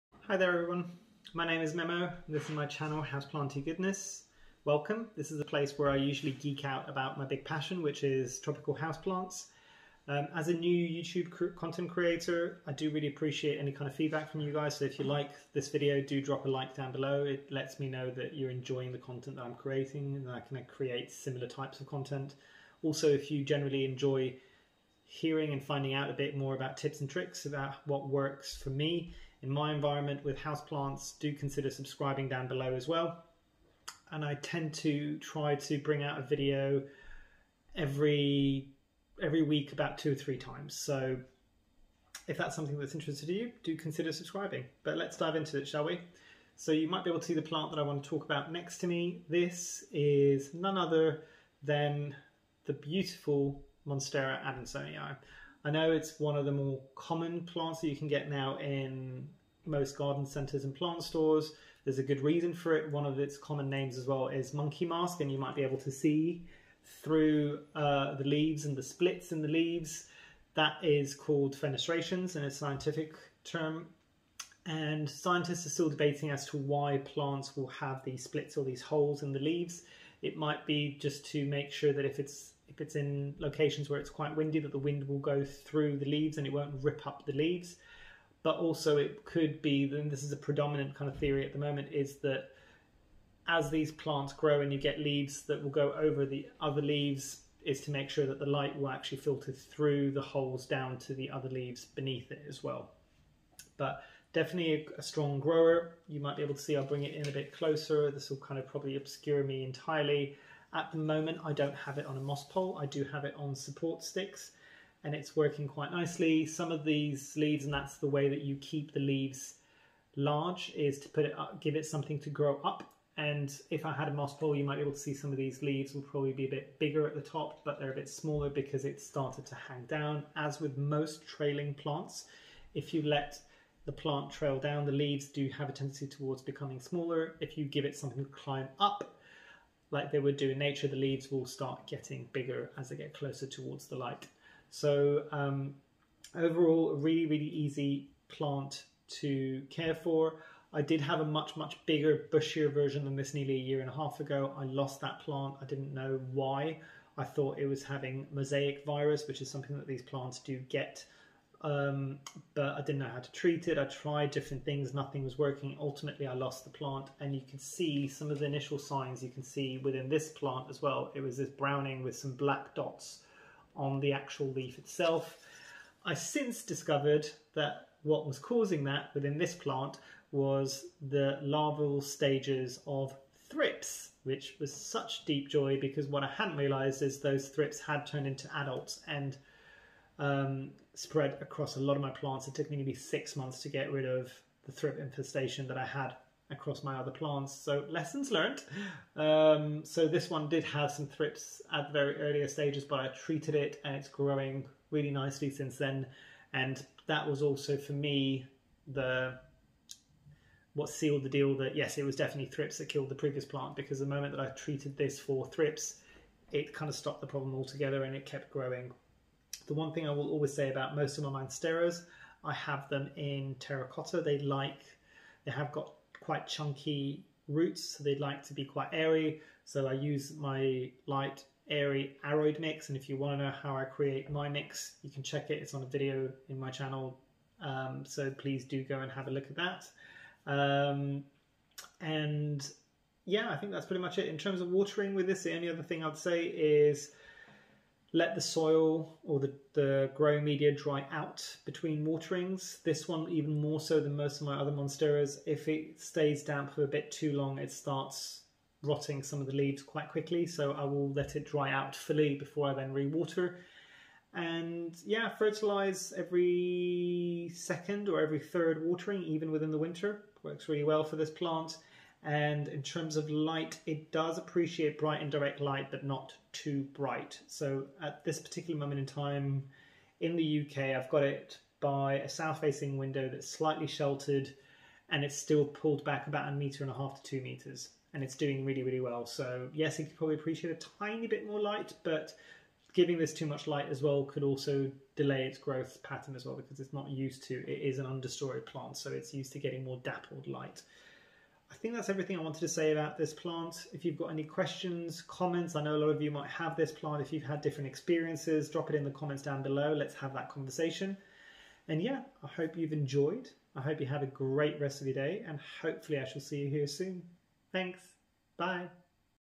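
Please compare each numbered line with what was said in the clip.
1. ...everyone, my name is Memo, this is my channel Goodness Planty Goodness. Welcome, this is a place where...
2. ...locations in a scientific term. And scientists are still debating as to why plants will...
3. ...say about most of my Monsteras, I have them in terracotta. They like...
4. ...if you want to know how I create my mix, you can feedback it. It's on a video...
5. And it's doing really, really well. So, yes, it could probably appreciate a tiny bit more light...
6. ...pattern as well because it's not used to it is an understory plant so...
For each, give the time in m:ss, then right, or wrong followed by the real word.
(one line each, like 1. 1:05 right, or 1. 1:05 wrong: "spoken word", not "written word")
1. 0:00 wrong: "House", not "Goodness"
2. 1:11 wrong: "fenestrations", not "locations"
3. 3:40 right
4. 3:52 wrong: "check", not "feedback"
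5. 4:48 right
6. 4:56 right.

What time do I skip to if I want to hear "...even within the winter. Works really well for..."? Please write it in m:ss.
4:29.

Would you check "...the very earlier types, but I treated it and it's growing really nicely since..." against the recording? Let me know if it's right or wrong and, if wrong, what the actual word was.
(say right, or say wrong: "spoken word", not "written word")
wrong: "stages", not "types".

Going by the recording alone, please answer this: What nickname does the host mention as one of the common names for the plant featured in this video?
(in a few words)
Monkey mask.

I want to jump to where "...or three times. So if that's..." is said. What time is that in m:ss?
0:40.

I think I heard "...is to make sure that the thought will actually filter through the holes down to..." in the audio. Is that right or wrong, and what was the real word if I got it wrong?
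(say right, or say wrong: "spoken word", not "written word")
wrong: "light", not "thought".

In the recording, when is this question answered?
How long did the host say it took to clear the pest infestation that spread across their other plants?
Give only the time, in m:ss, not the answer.
3:12.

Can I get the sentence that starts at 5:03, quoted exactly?
If you've got any questions, comments, I know a lot of you might have this plant.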